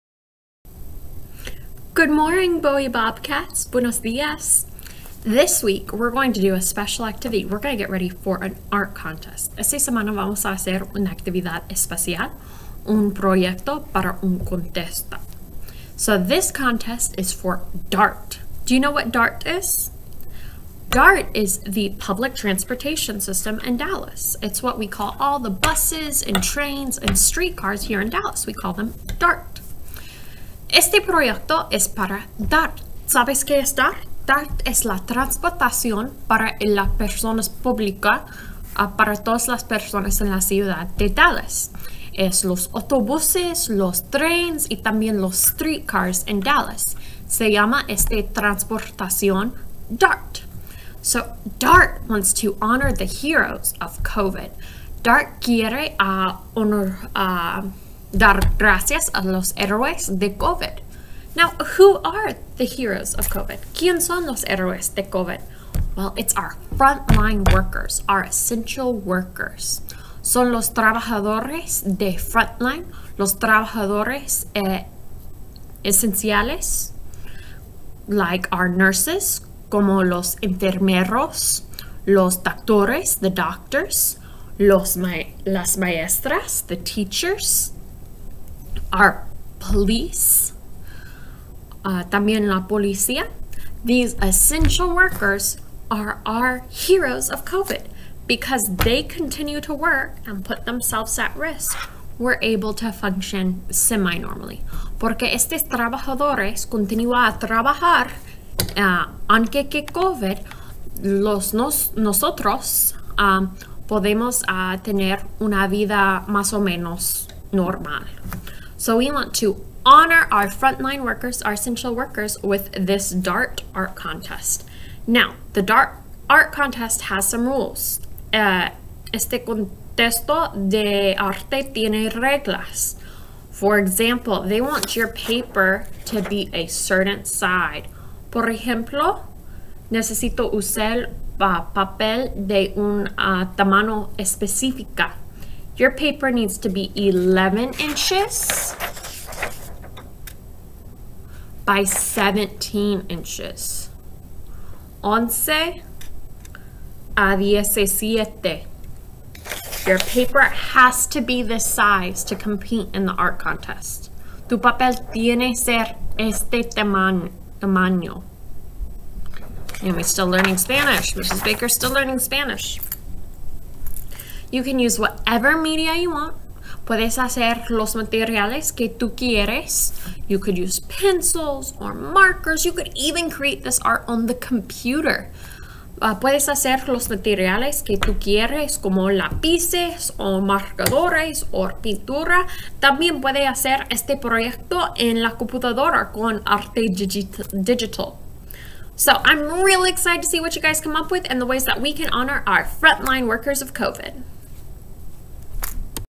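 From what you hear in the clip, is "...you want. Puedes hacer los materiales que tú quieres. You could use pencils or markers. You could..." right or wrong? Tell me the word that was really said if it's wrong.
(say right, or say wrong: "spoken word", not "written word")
right.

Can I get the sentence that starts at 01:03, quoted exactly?
¿Quién son los héroes de COVID?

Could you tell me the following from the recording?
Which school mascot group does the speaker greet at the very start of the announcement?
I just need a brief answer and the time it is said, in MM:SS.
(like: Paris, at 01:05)
Bowie Bobcats, at 00:02.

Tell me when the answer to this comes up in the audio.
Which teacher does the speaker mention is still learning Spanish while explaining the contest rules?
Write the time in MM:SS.
02:51.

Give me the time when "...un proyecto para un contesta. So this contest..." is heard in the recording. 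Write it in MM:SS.
00:12.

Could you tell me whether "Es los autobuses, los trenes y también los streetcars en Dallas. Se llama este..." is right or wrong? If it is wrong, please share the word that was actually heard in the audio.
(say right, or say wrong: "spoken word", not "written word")
right.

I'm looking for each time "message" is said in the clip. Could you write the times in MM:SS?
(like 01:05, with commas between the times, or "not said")
not said.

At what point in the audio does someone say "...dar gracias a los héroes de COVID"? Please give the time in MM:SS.
00:58.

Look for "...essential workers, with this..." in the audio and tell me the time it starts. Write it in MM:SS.
02:01.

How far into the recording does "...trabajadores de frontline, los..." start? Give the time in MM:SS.
01:10.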